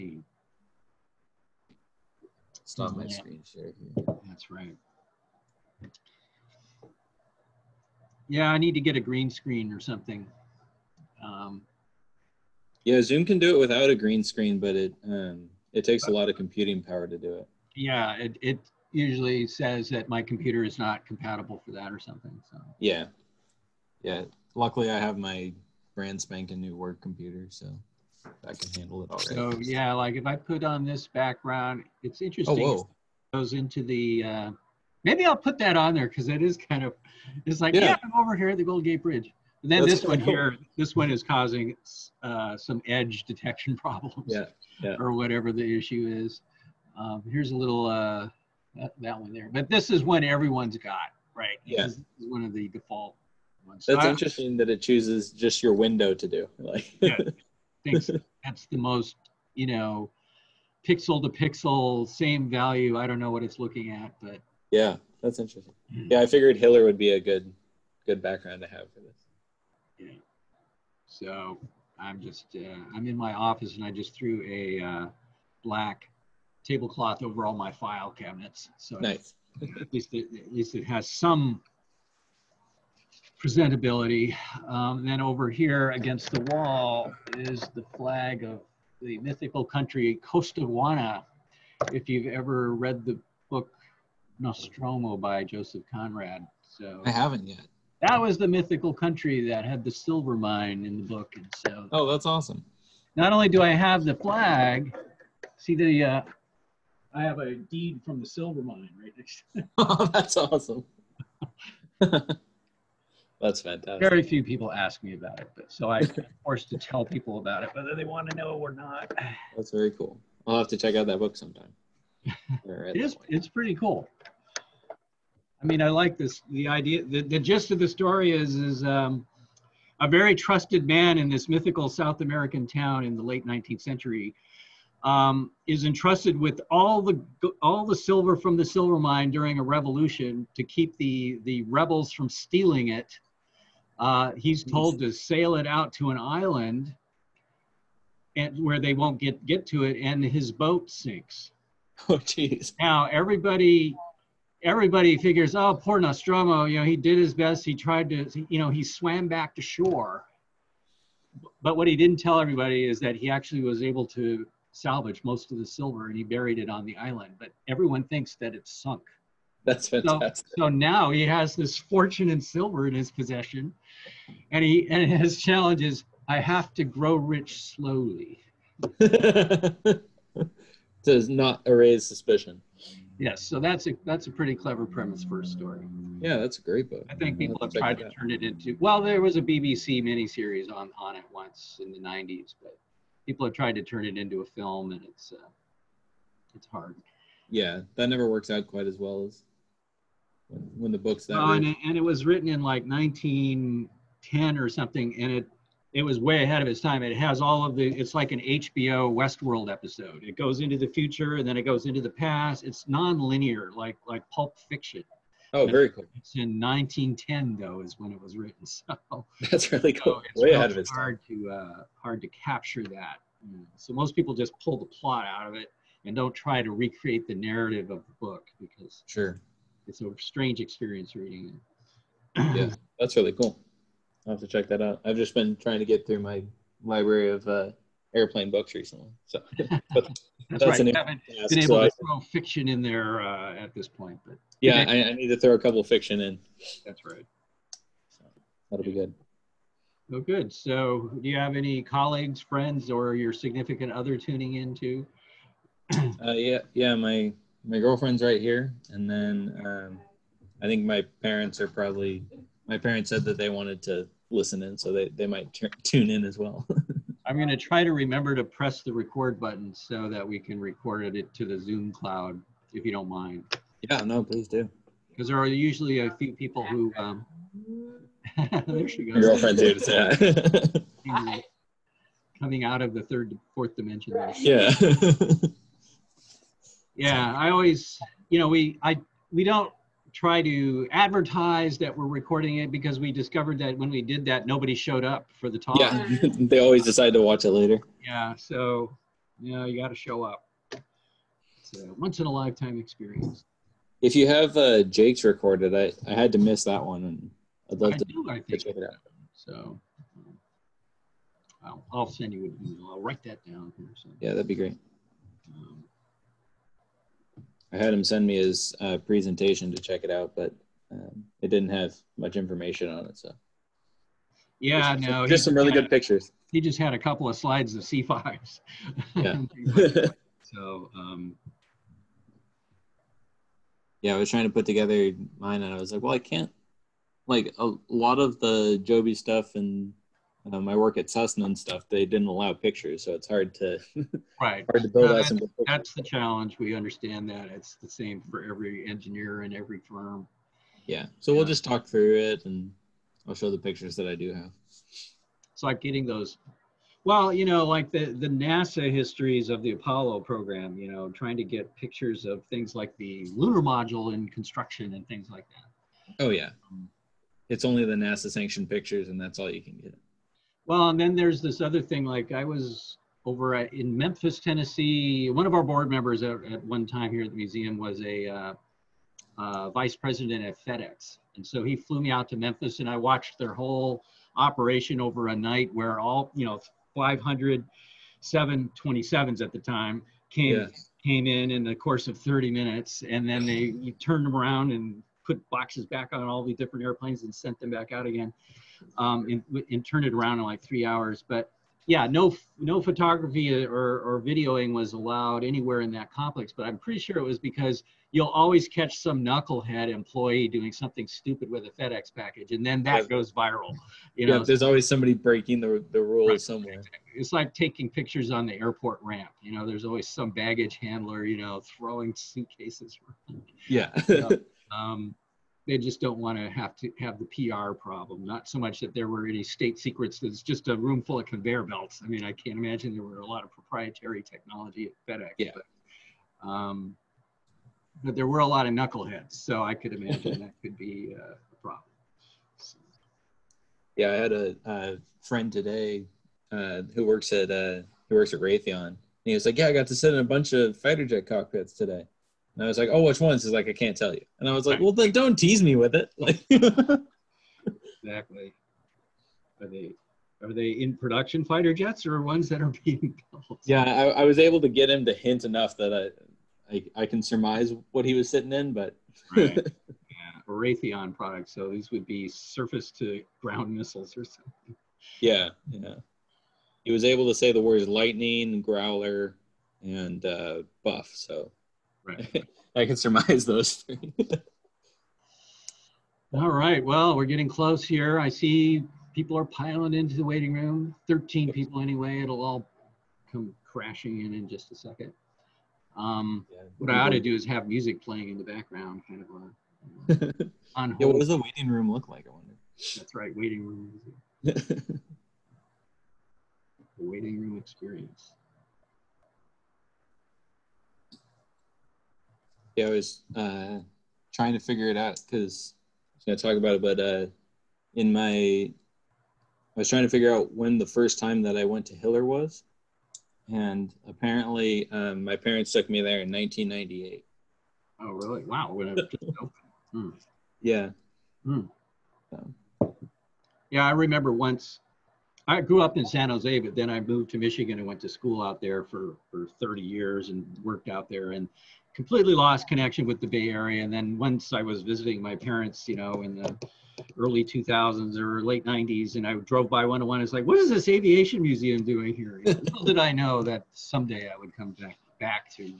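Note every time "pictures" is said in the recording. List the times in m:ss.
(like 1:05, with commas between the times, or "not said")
5:25, 5:42, 5:53, 6:01, 6:08, 6:57.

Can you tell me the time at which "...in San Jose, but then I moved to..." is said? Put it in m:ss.
8:55.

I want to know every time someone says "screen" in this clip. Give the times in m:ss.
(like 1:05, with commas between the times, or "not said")
0:03, 0:09, 0:14.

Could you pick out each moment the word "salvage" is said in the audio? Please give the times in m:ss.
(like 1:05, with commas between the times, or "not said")
2:44.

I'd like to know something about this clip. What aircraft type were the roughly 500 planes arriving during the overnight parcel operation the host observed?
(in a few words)
727s.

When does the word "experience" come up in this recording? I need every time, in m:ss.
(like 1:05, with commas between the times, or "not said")
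3:50, 5:02, 8:27.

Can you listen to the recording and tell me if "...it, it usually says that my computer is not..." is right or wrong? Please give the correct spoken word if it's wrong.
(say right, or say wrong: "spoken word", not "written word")
right.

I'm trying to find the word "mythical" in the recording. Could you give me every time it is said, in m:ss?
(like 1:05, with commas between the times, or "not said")
1:29, 1:38, 2:11.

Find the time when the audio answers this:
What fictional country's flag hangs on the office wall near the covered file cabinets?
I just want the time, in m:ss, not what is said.
1:30.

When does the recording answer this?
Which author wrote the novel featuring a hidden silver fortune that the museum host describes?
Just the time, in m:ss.
1:35.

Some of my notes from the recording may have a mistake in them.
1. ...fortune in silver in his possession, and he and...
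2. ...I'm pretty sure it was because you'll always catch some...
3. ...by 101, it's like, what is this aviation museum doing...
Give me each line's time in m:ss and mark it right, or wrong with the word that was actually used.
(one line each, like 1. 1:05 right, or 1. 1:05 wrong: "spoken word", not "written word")
1. 2:51 right
2. 6:46 right
3. 9:09 right.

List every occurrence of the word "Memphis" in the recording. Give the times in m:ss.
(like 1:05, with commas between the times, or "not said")
6:13, 6:22.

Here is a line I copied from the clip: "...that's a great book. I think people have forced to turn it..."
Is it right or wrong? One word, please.
wrong.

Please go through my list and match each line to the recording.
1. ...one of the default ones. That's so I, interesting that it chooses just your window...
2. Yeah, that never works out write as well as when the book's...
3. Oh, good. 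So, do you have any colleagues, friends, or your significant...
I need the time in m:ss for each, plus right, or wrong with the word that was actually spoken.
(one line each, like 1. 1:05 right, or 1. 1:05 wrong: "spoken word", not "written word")
1. 0:52 right
2. 3:17 wrong: "quite", not "write"
3. 4:10 right.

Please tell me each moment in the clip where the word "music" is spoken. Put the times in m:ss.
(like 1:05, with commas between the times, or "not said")
8:17, 8:23.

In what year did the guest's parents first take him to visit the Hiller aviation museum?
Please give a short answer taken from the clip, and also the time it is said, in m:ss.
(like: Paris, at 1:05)
1998, at 8:46.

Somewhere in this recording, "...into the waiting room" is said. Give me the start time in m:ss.
8:09.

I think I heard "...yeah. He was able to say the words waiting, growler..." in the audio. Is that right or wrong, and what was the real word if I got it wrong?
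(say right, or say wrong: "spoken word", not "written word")
wrong: "lightning", not "waiting".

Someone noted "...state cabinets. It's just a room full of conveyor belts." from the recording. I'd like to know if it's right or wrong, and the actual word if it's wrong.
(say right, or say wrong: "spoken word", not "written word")
wrong: "secrets", not "cabinets".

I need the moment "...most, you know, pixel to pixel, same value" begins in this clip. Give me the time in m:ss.
0:58.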